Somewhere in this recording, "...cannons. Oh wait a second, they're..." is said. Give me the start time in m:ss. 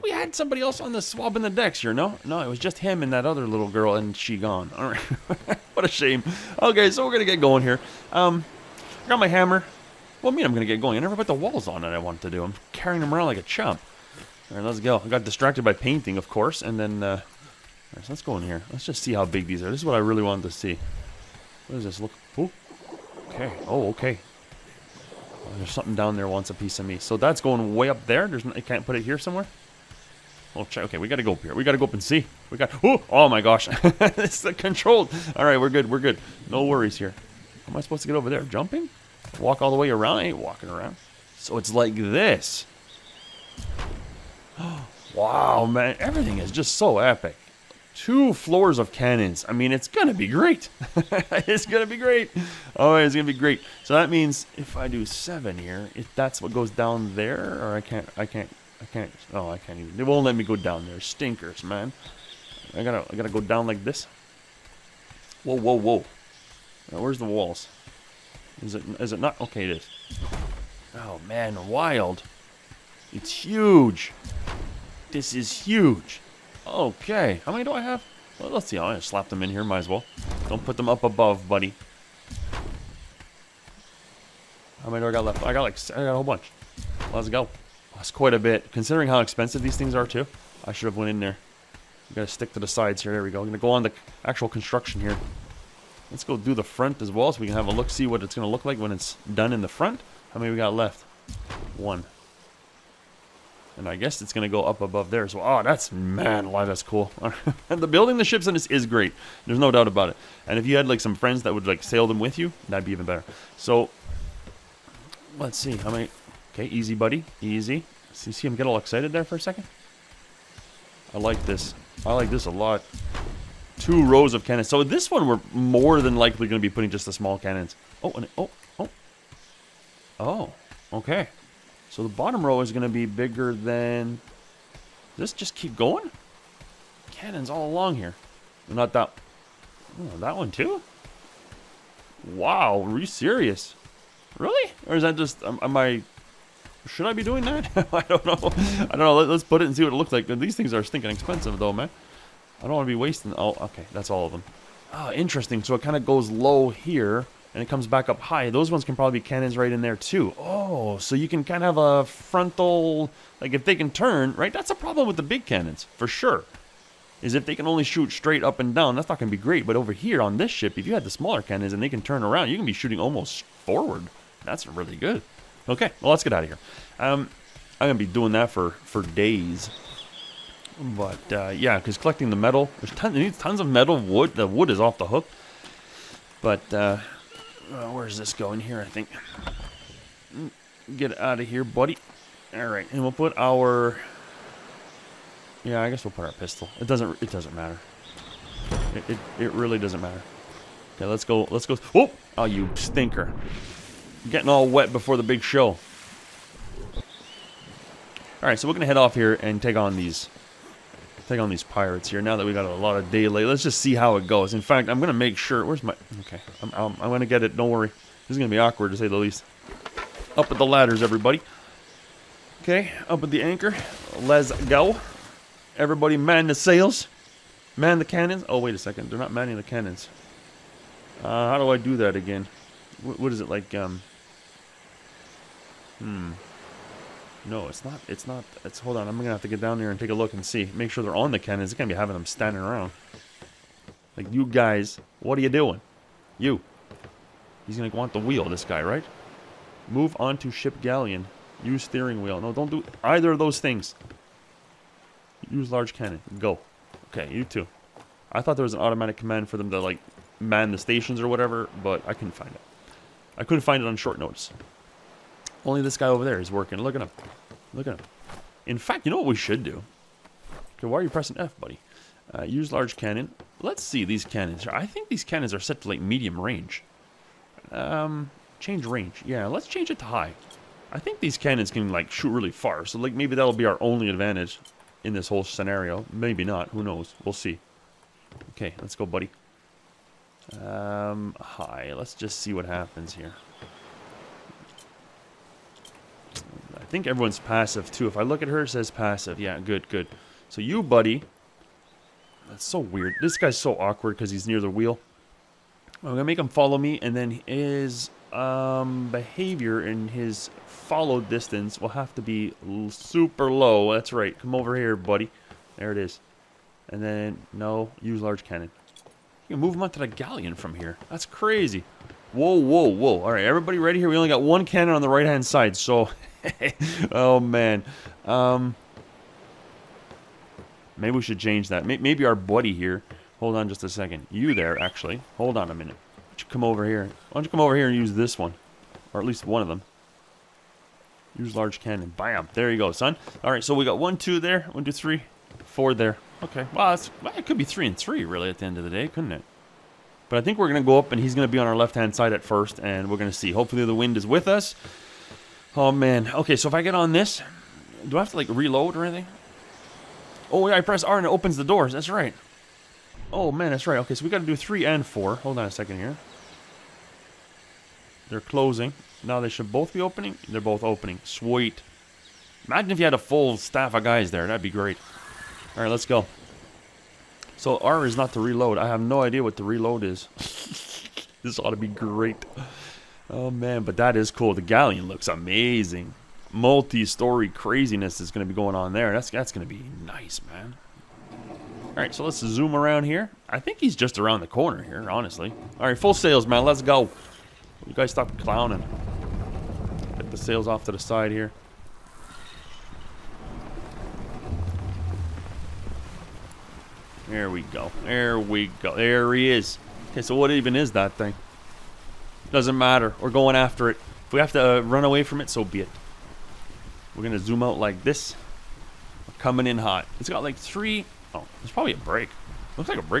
3:48.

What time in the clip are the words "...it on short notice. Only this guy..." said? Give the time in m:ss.
4:23.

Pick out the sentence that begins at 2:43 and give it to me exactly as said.
Like, if they can turn, right?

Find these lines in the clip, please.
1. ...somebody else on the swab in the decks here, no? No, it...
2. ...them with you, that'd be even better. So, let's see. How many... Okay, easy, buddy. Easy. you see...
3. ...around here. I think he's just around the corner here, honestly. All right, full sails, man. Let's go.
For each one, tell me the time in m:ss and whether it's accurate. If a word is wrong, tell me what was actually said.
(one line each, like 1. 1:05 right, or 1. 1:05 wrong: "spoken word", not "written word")
1. 0:00 right
2. 1:52 right
3. 6:32 right.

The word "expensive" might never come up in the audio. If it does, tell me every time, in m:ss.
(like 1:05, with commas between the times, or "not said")
1:29, 2:31.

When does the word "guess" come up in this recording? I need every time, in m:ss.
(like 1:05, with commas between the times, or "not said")
1:43, 3:15.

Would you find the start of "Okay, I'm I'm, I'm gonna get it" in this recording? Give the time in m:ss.
3:36.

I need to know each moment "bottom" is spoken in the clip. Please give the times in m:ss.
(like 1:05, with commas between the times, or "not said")
2:12.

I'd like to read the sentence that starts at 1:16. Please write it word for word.
Okay, how many do I have?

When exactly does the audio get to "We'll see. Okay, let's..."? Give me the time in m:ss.
4:47.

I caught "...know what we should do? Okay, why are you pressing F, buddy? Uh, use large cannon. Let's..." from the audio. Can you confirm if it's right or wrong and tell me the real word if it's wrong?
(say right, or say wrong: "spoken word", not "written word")
right.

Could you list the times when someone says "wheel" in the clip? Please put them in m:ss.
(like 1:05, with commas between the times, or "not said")
4:08, 4:12, 5:04.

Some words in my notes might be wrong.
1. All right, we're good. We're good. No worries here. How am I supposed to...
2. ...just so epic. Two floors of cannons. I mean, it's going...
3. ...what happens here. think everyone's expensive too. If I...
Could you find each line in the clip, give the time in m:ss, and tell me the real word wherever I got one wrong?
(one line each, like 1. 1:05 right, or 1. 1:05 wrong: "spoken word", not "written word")
1. 0:35 right
2. 0:46 right
3. 4:52 wrong: "passive", not "expensive".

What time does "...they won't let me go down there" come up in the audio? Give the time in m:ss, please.
0:59.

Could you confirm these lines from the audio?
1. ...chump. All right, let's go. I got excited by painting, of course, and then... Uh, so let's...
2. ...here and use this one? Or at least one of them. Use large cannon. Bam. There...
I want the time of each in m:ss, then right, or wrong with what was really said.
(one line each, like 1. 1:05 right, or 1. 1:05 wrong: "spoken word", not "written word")
1. 0:13 wrong: "distracted", not "excited"
2. 5:37 right.